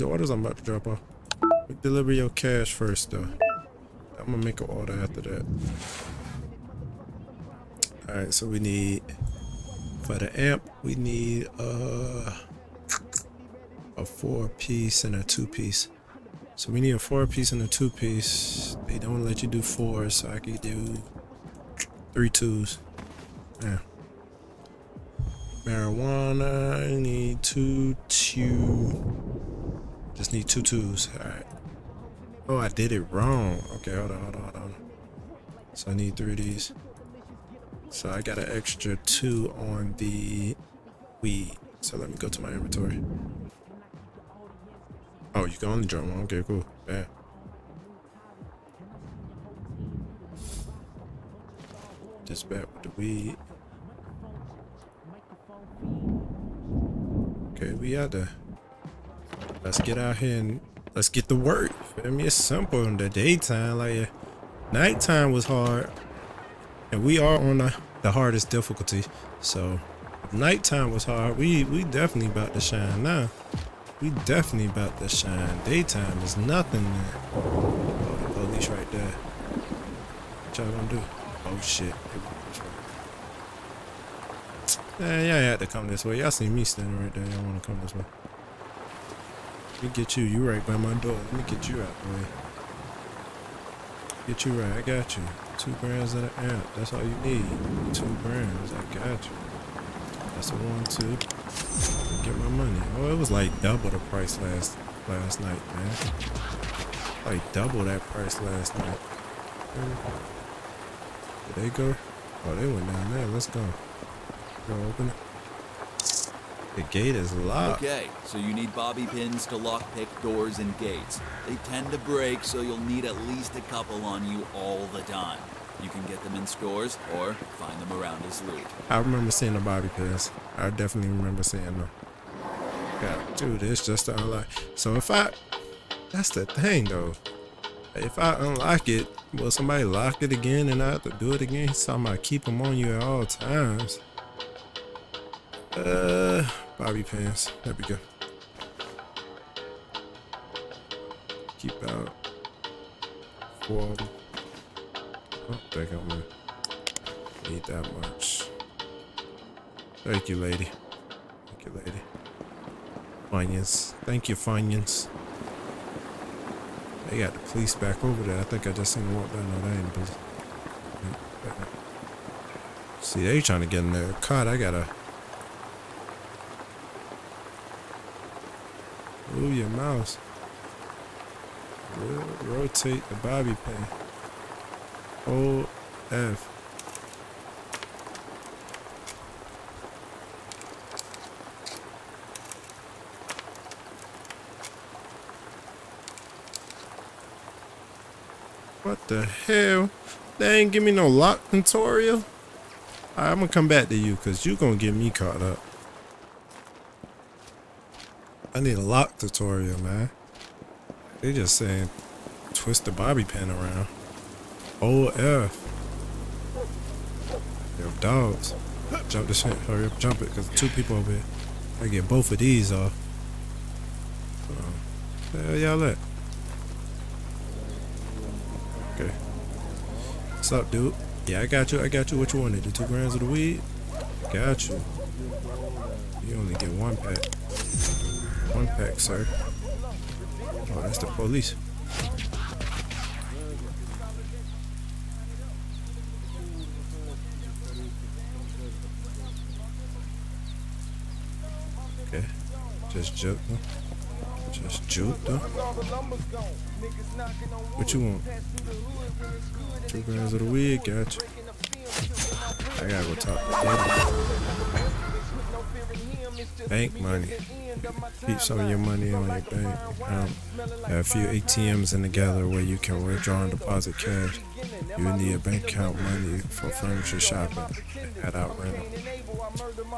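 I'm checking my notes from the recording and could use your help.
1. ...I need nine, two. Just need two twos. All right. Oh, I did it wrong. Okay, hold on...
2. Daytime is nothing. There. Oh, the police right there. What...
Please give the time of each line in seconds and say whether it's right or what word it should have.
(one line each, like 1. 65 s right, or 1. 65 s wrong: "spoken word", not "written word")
1. 26 s wrong: "two", not "nine"
2. 75 s right.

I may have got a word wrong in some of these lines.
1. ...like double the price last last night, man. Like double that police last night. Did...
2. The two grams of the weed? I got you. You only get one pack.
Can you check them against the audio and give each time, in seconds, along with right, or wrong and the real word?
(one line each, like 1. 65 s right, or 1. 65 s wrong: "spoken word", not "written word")
1. 103 s wrong: "price", not "police"
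2. 232 s right.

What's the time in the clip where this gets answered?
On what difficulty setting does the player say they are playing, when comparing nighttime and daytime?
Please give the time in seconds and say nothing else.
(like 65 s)
68 s.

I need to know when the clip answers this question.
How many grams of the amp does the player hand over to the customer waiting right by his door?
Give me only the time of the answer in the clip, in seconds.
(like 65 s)
95 s.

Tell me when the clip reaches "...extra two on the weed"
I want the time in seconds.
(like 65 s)
38 s.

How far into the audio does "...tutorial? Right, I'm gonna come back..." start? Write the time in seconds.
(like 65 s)
201 s.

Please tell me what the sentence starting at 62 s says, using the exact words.
I mean, it's simple in the daytime.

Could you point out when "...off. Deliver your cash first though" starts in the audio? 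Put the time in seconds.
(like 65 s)
0 s.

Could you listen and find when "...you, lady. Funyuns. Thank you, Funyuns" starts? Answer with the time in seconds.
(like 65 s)
161 s.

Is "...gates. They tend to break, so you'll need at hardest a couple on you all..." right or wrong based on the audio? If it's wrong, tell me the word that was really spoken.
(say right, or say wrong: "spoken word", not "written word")
wrong: "least", not "hardest".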